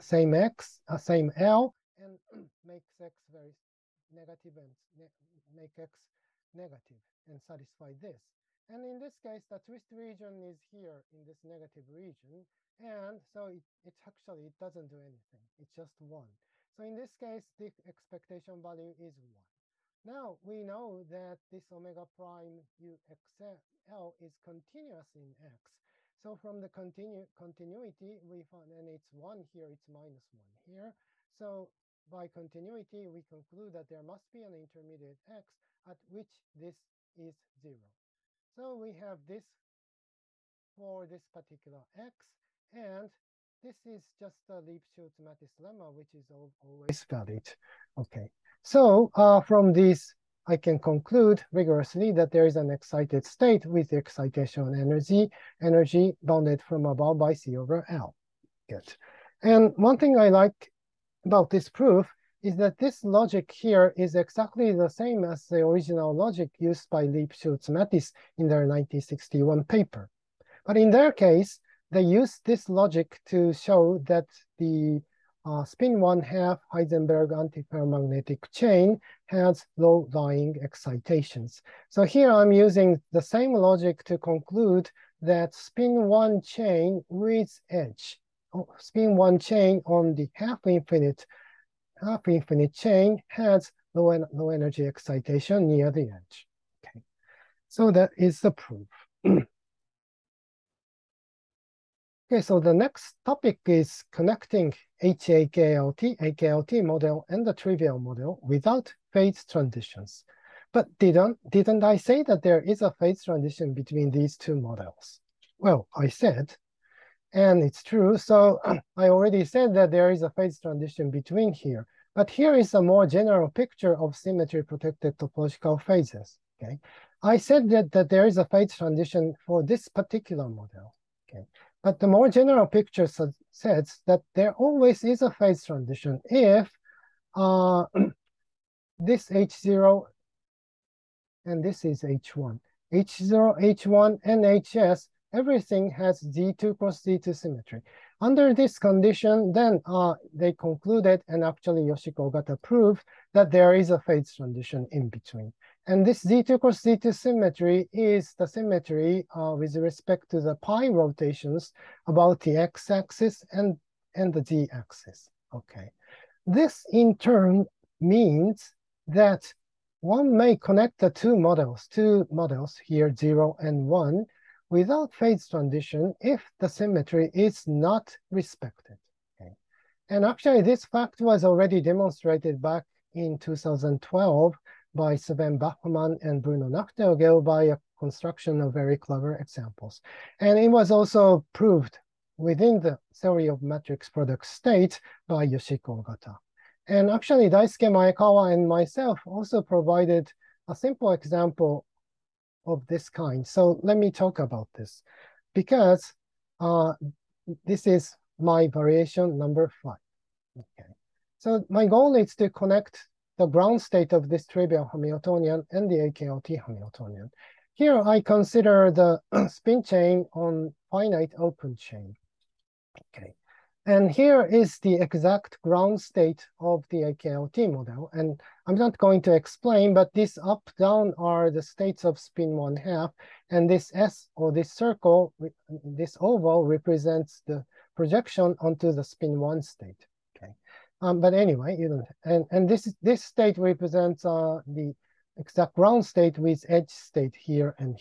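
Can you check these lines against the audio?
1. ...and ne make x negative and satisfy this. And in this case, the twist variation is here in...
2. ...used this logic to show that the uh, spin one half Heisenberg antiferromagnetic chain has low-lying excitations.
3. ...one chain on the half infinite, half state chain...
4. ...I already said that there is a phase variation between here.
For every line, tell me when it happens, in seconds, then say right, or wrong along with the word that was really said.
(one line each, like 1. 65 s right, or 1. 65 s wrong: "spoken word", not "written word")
1. 4 s wrong: "region", not "variation"
2. 72 s right
3. 89 s wrong: "infinite", not "state"
4. 118 s wrong: "transition", not "variation".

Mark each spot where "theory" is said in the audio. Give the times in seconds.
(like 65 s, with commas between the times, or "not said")
193 s.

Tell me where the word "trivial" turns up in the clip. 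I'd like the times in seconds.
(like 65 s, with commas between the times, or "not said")
107 s, 214 s.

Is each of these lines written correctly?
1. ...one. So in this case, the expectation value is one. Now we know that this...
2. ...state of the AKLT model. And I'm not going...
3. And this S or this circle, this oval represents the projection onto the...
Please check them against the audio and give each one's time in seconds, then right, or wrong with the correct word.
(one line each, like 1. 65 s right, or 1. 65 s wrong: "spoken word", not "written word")
1. 16 s right
2. 226 s right
3. 233 s right.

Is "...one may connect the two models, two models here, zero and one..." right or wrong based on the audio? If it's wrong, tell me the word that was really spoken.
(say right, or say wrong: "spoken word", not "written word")
right.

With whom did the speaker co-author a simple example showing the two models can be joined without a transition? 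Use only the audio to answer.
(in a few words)
Daisuke Maekawa.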